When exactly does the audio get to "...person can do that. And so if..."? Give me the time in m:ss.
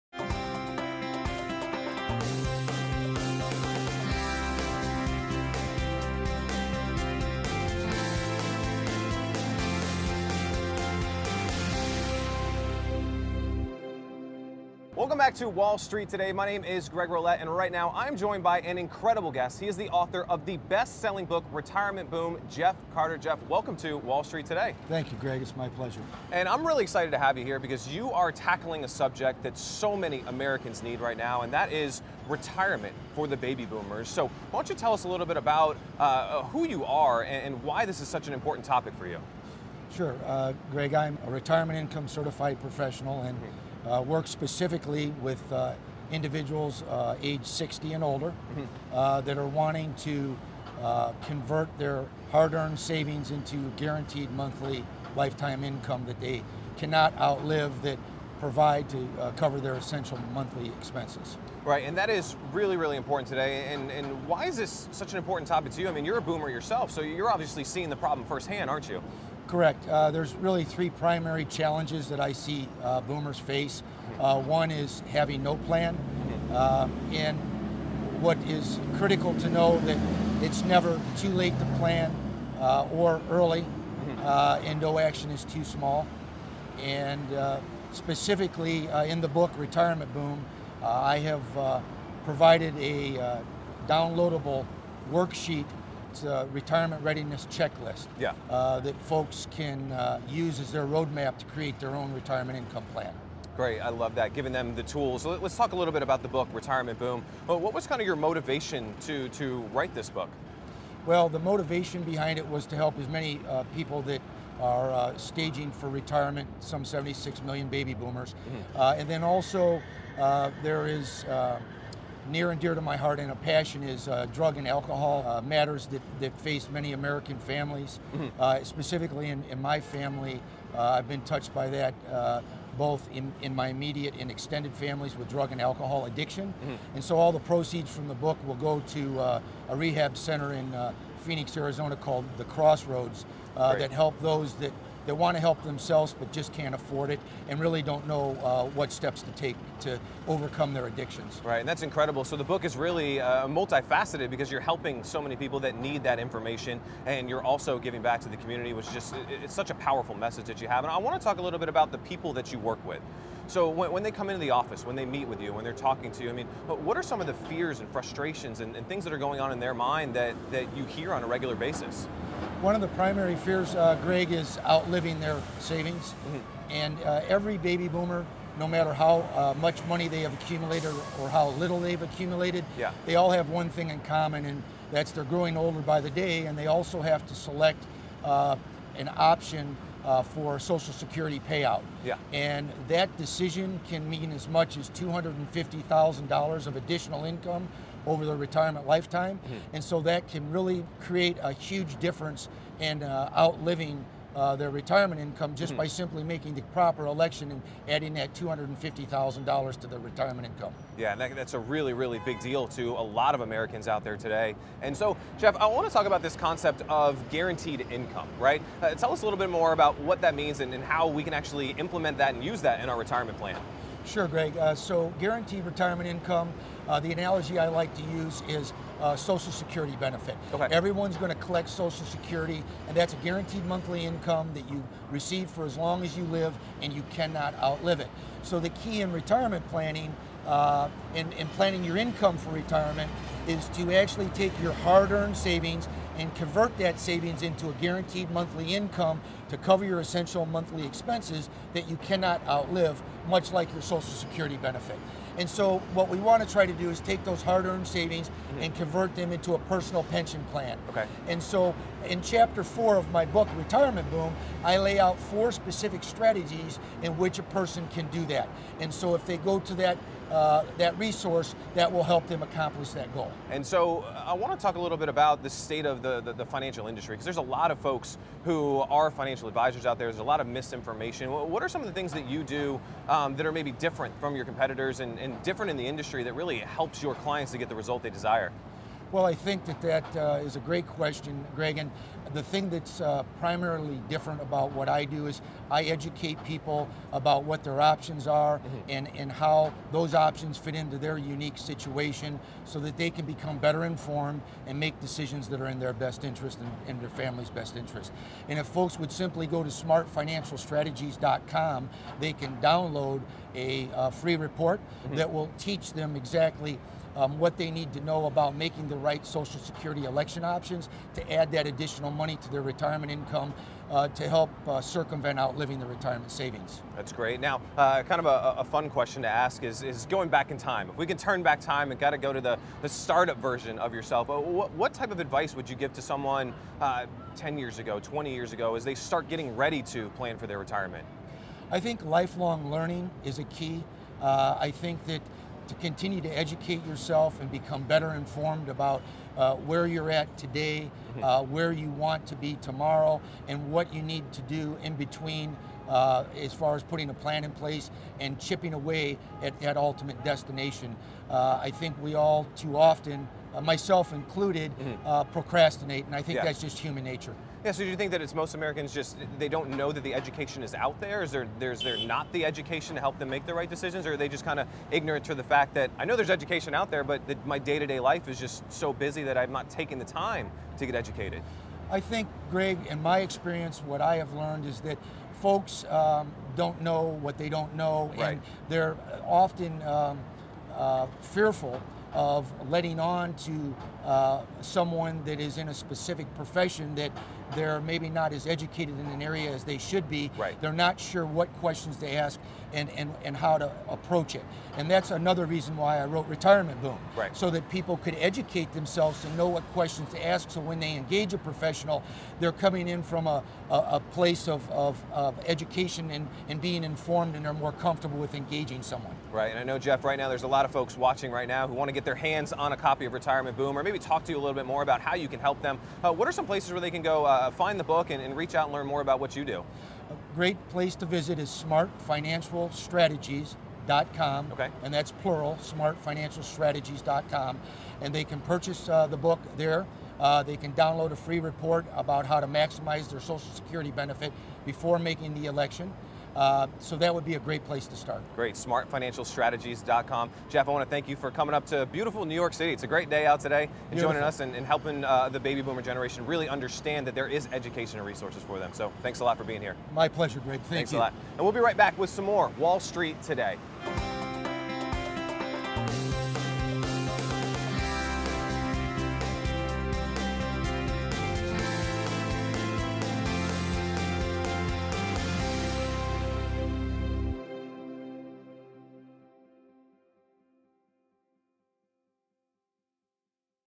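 4:27.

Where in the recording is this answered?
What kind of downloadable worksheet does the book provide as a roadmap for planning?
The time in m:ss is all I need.
1:36.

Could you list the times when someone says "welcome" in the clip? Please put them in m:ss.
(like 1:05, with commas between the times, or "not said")
0:15, 0:23.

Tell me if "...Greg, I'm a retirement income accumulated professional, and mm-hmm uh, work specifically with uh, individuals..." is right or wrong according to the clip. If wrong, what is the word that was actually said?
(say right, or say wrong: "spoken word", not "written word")
wrong: "certified", not "accumulated".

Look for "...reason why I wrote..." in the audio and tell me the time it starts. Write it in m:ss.
6:45.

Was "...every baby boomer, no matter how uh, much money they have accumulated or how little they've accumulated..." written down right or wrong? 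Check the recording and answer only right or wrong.
right.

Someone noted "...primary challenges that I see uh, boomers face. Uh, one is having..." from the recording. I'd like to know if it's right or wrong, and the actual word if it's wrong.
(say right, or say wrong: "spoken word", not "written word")
right.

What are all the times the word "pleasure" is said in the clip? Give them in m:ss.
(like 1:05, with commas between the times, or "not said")
0:25, 7:40.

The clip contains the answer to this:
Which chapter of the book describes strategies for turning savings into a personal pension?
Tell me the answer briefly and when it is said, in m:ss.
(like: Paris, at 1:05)
Chapter 4, at 4:22.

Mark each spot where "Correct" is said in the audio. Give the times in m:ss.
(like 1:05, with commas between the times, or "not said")
1:09.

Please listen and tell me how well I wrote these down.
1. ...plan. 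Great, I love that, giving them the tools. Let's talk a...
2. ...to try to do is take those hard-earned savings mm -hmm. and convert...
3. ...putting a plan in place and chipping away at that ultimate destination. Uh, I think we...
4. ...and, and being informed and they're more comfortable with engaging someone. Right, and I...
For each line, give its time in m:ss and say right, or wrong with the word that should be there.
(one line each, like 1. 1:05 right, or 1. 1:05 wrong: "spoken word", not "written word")
1. 1:42 right
2. 4:16 right
3. 5:56 right
4. 6:56 right.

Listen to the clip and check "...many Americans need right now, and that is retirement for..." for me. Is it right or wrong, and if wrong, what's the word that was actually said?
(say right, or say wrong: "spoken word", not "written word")
right.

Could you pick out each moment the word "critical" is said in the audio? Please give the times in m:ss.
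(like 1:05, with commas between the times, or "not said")
1:18.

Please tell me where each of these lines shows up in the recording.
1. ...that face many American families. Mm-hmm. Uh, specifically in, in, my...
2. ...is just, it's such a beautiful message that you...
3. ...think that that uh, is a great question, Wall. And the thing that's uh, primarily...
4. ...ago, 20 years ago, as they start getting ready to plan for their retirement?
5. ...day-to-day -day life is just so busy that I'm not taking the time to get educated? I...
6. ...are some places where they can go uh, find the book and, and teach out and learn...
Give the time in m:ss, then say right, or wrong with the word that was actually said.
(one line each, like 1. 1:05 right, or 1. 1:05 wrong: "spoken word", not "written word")
1. 2:06 right
2. 2:38 wrong: "powerful", not "beautiful"
3. 4:49 wrong: "Greg", not "Wall"
4. 5:37 right
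5. 6:17 right
6. 7:06 wrong: "reach", not "teach".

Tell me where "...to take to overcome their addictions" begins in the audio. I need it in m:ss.
2:29.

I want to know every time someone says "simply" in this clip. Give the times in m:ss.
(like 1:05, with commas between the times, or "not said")
3:26, 5:09.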